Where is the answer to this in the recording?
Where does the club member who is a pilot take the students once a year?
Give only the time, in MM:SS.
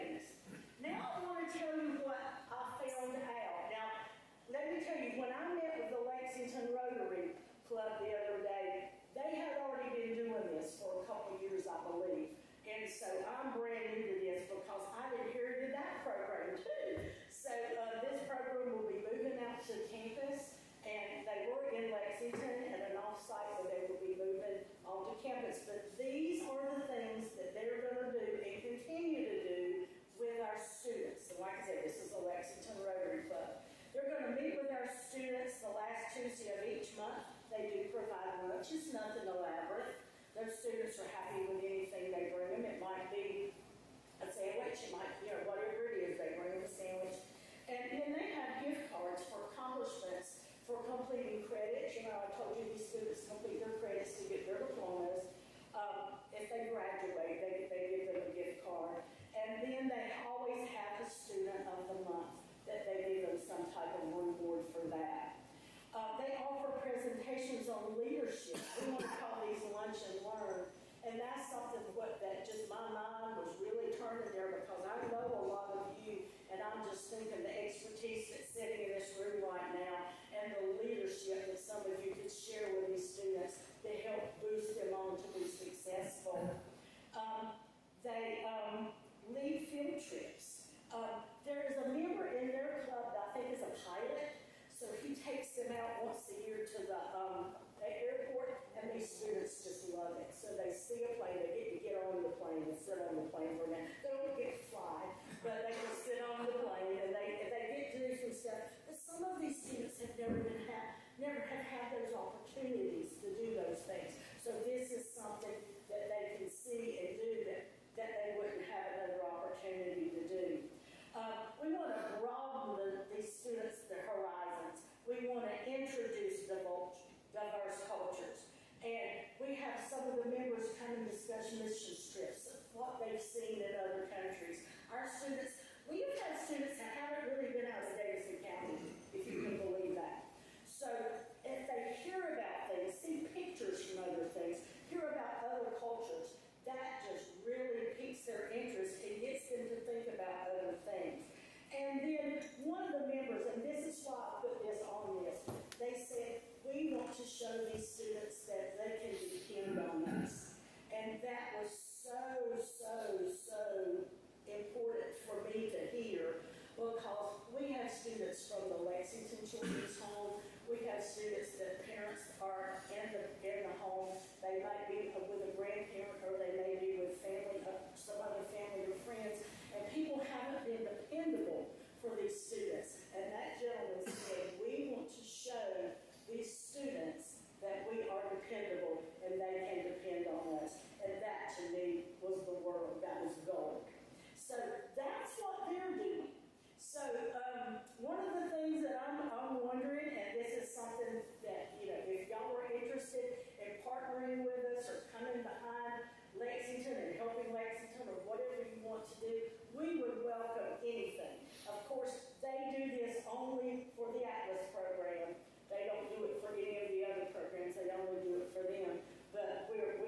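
01:37.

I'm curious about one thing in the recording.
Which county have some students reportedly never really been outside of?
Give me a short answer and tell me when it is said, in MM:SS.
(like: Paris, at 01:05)
Davidson County, at 02:17.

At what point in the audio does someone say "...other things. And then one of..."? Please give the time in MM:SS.
02:30.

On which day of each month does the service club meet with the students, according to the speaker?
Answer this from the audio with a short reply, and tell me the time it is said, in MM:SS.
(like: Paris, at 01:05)
Last Tuesday, at 00:35.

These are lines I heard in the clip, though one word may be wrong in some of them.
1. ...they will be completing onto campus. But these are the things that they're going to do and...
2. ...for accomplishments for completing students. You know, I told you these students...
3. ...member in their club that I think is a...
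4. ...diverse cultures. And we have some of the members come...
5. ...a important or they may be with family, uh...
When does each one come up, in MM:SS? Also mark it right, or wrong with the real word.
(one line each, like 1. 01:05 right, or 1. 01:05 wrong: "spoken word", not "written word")
1. 00:23 wrong: "moving", not "completing"
2. 00:49 wrong: "credits", not "students"
3. 01:31 right
4. 02:06 right
5. 02:55 wrong: "grandparent", not "important".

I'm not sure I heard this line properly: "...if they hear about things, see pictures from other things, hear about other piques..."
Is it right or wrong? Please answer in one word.
wrong.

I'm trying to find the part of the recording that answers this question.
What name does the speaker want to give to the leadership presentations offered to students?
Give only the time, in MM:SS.
01:09.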